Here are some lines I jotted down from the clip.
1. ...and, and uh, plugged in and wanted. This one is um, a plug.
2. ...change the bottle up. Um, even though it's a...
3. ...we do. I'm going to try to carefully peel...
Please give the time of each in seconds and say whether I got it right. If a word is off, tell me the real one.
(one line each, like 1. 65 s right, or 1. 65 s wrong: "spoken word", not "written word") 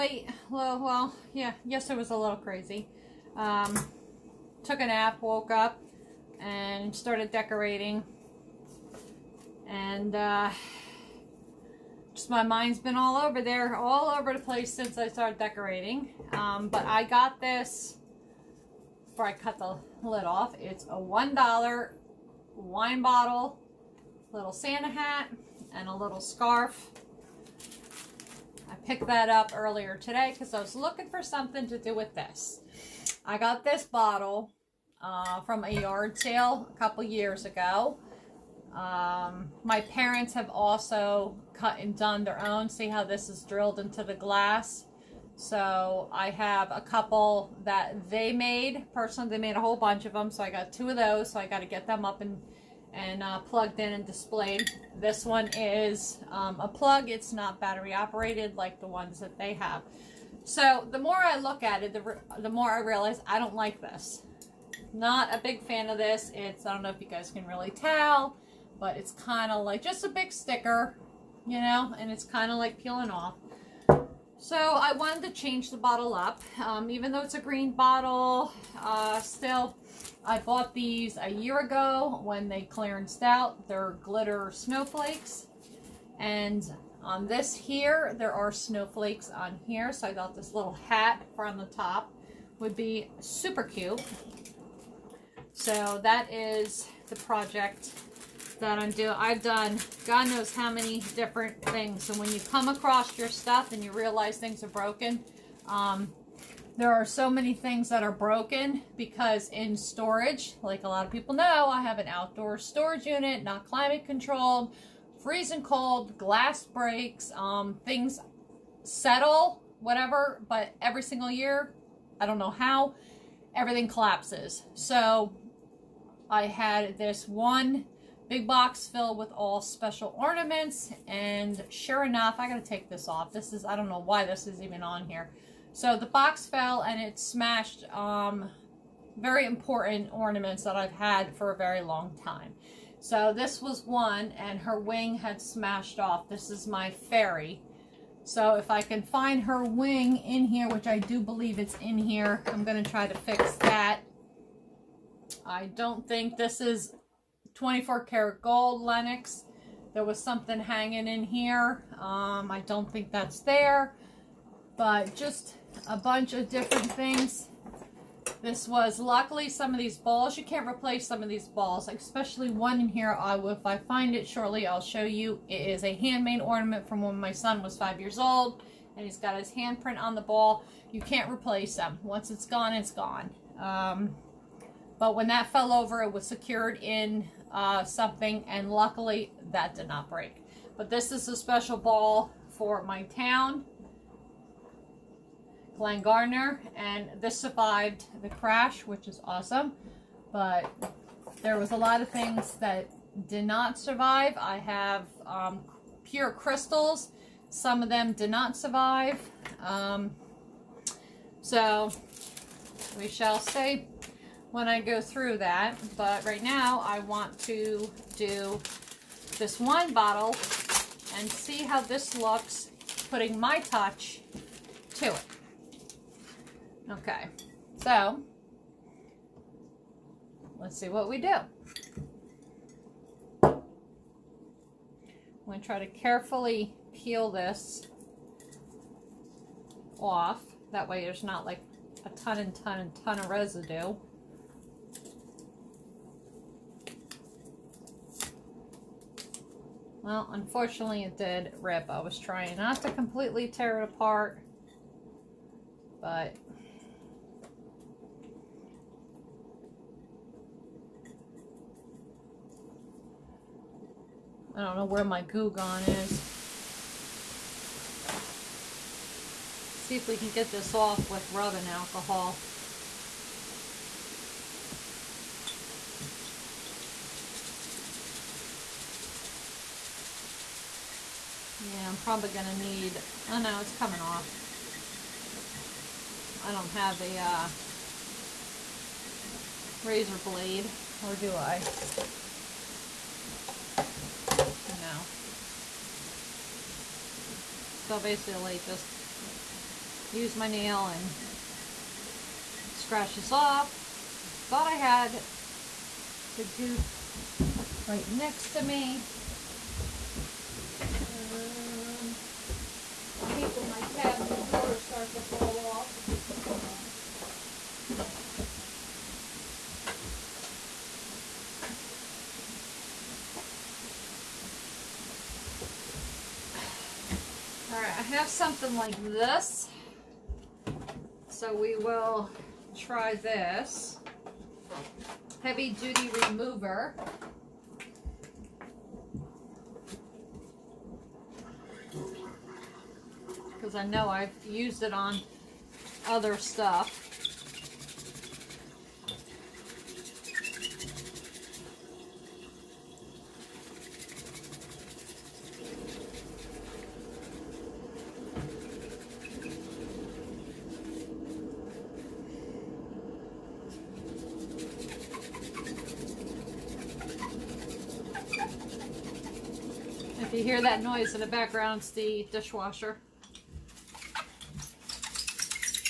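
1. 52 s wrong: "displayed", not "wanted"
2. 75 s right
3. 231 s right.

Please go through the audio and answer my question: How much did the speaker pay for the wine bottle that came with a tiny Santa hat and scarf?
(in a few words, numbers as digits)
$1.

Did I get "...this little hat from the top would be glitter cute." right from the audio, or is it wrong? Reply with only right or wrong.
wrong.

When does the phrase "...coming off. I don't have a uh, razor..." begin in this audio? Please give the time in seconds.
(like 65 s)
283 s.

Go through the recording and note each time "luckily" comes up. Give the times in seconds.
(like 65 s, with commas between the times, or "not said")
168 s, 188 s.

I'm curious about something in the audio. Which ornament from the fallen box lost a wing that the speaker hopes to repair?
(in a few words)
fairy.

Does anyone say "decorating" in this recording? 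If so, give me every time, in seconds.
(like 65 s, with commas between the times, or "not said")
7 s, 15 s.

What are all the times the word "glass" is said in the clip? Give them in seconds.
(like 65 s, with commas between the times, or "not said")
44 s, 116 s.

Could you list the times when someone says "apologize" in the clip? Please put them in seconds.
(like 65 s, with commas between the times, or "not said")
not said.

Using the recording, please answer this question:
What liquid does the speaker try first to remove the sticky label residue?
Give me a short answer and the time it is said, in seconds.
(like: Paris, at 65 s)
rubbing alcohol, at 271 s.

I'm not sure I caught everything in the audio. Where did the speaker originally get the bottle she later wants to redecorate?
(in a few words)
a yard sale.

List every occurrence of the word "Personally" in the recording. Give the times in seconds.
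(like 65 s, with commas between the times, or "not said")
48 s.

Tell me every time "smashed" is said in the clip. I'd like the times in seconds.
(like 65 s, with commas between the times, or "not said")
137 s, 145 s.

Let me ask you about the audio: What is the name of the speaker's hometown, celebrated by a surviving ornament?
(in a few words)
Glen Gardner.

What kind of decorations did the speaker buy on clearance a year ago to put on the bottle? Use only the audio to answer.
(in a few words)
glitter snowflakes.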